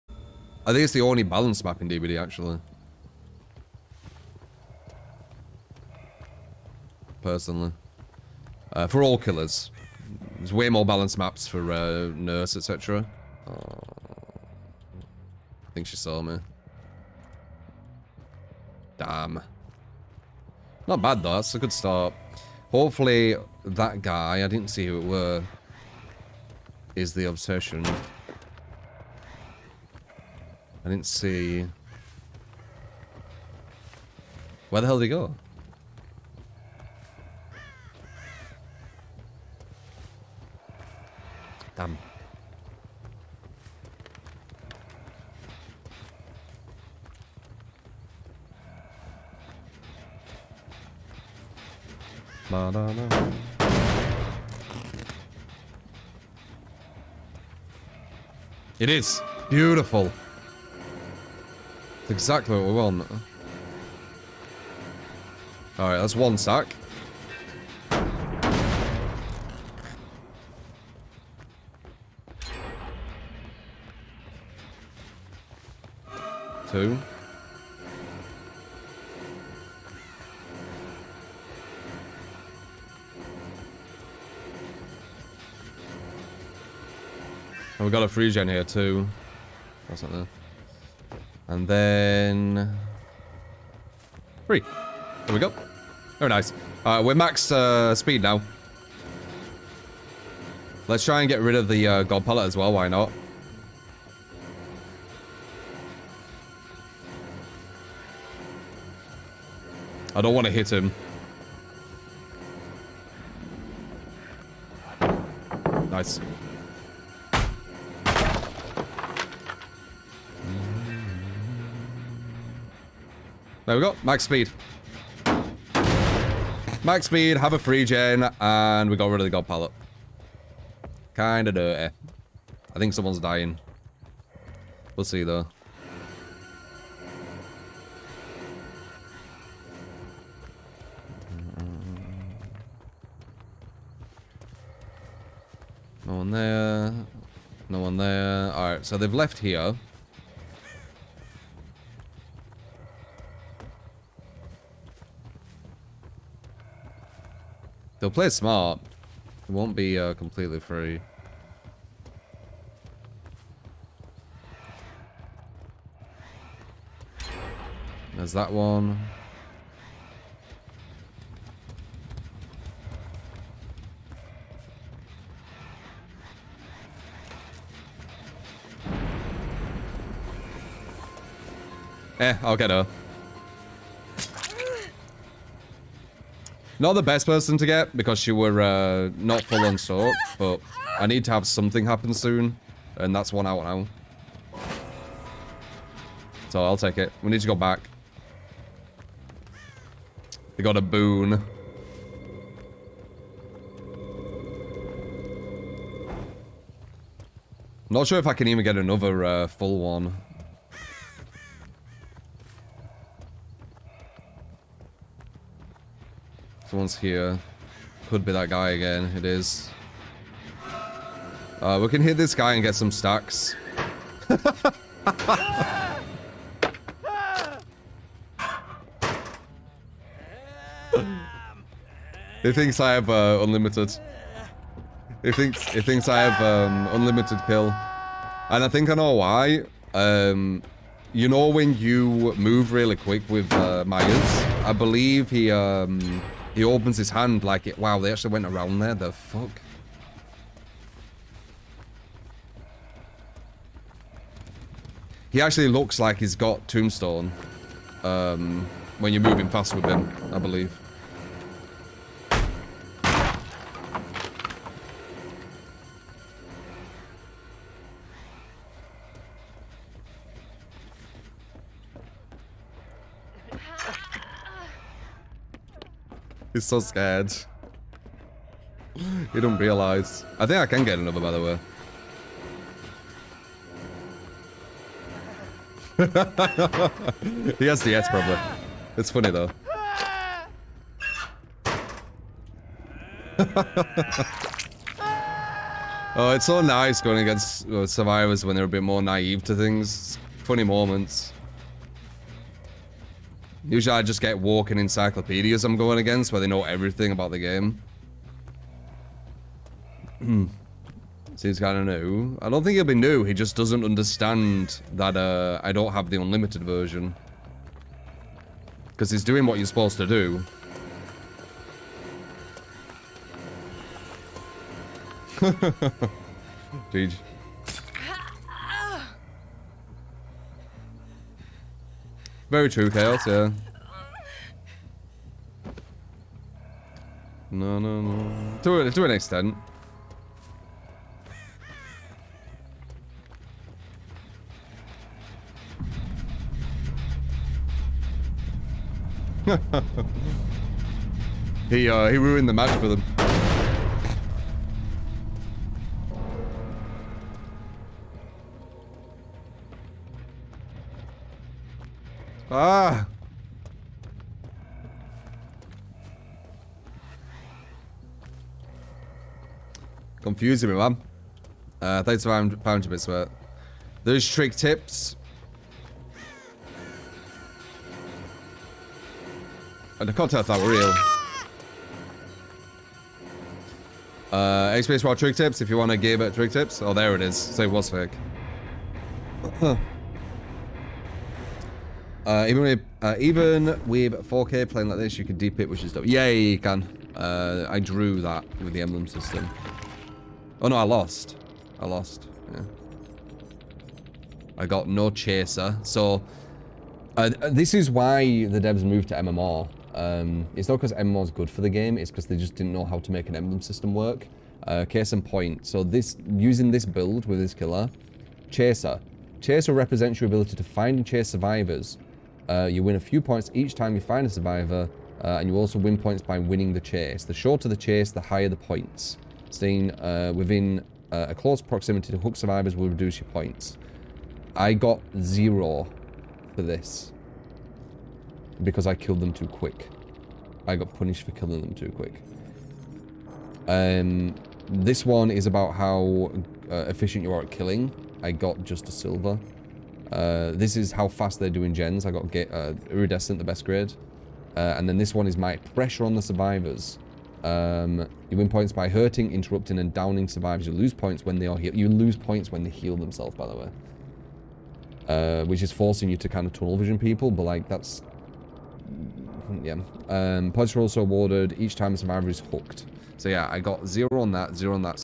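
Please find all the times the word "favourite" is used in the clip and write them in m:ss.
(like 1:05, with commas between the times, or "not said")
not said.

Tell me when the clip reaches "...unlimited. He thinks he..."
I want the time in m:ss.
3:53.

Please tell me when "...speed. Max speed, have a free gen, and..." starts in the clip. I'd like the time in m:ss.
2:04.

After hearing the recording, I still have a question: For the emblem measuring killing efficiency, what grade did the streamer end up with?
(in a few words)
Silver.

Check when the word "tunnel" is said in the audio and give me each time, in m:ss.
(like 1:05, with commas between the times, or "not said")
7:46.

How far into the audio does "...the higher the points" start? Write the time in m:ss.
7:08.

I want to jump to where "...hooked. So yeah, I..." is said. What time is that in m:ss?
7:52.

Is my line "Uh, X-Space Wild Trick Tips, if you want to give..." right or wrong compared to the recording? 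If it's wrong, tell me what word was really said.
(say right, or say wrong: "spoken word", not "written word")
right.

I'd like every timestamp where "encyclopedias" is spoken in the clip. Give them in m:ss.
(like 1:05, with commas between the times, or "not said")
5:04.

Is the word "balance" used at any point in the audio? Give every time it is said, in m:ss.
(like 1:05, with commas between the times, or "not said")
0:01, 0:10.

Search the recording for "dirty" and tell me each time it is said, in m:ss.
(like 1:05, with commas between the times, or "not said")
2:11.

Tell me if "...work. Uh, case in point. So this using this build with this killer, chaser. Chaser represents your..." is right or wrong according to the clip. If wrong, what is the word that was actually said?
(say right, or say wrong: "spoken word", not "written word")
right.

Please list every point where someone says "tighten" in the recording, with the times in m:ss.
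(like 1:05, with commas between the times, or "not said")
not said.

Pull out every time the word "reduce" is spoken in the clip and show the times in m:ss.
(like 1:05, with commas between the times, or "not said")
7:12.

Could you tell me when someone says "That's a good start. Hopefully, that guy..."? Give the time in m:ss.
0:21.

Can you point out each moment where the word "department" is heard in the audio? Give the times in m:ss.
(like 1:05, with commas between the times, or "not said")
not said.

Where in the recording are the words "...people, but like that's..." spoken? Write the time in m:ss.
7:46.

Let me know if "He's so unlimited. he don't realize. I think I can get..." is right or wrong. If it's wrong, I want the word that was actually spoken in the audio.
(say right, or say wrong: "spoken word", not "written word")
wrong: "scared", not "unlimited".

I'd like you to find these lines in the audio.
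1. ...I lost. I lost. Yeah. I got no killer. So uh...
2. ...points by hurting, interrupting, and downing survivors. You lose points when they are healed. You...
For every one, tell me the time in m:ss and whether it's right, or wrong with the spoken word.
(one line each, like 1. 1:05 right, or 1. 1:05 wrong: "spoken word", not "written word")
1. 6:40 wrong: "chaser", not "killer"
2. 7:38 right.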